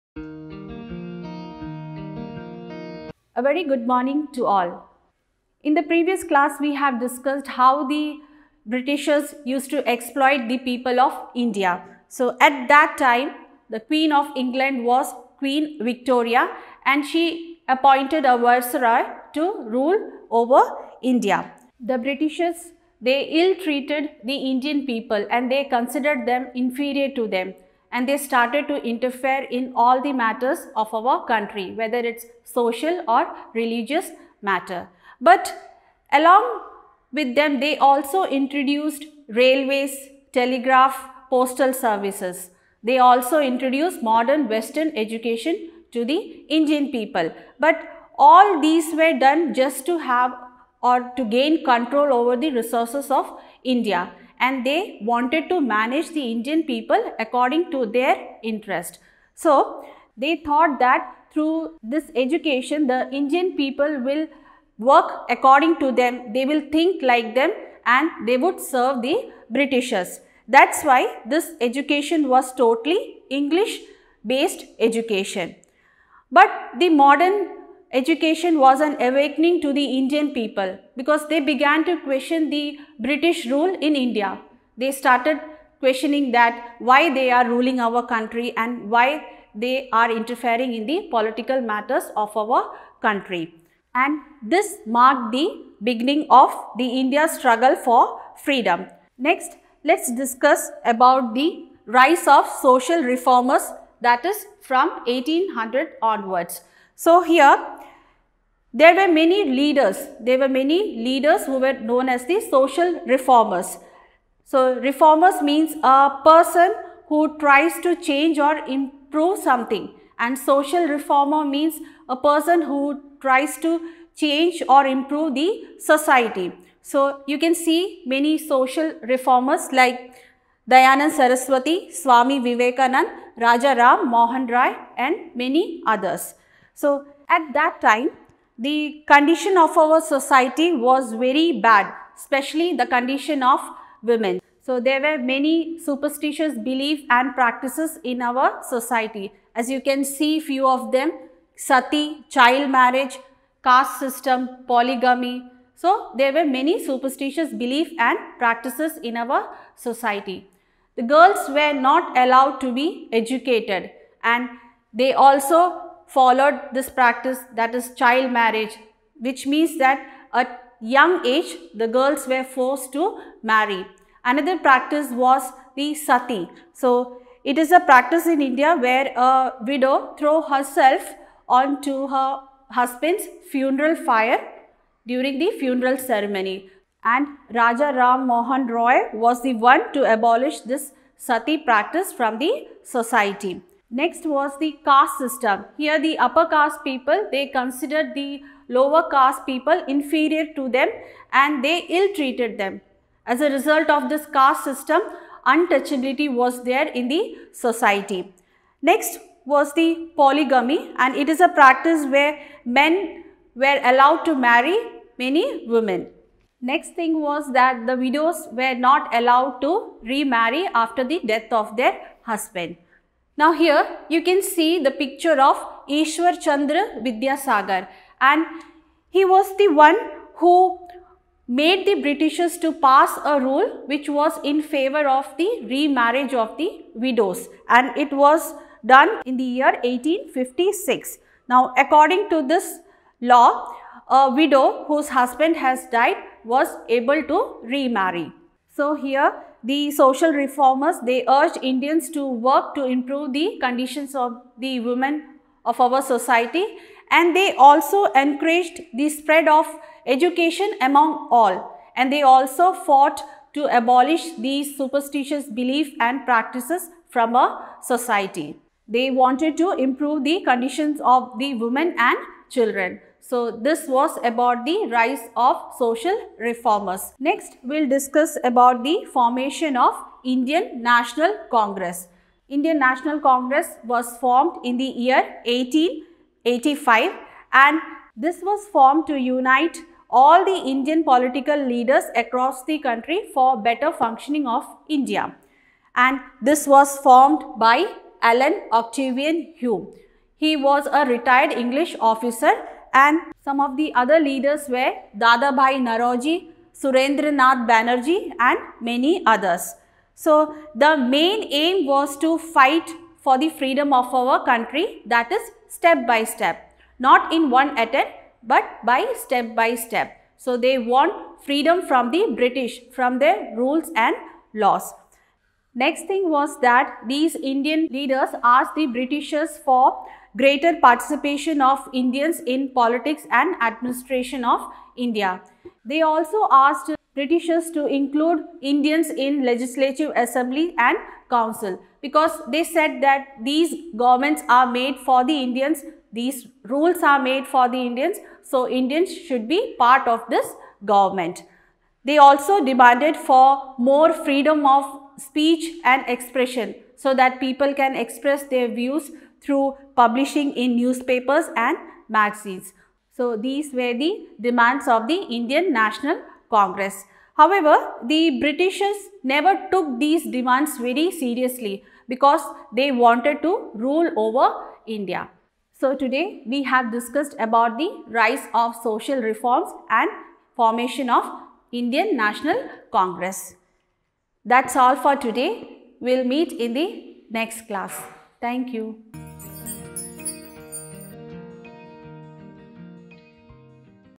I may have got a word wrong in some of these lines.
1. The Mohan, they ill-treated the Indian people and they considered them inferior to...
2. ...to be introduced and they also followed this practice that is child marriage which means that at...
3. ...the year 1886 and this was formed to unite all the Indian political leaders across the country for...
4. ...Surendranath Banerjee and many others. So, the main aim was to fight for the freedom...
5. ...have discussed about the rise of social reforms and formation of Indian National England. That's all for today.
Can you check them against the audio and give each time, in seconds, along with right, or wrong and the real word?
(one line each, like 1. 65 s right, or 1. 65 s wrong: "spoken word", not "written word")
1. 21 s wrong: "Britishers", not "Mohan"
2. 162 s wrong: "educated", not "introduced"
3. 284 s wrong: "1885", not "1886"
4. 306 s right
5. 376 s wrong: "Congress", not "England".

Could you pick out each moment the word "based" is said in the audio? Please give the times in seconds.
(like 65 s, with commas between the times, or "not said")
74 s.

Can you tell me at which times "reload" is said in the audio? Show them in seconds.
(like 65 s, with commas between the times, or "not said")
not said.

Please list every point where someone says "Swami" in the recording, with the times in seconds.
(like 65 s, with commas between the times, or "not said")
131 s.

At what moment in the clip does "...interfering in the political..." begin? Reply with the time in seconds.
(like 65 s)
90 s.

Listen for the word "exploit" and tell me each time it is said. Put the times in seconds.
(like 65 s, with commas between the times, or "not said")
9 s.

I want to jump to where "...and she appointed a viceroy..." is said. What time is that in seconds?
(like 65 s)
16 s.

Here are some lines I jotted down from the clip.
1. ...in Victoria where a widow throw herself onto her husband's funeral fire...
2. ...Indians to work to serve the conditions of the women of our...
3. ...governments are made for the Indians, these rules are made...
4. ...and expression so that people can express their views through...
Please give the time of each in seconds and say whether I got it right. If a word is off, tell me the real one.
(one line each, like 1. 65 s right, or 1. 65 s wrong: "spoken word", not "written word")
1. 178 s wrong: "India", not "Victoria"
2. 251 s wrong: "improve", not "serve"
3. 343 s right
4. 355 s right.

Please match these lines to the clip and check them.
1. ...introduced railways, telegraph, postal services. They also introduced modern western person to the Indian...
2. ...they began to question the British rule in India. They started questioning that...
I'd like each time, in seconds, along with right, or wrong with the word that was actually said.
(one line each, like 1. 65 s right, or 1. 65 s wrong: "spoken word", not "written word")
1. 38 s wrong: "education", not "person"
2. 81 s right.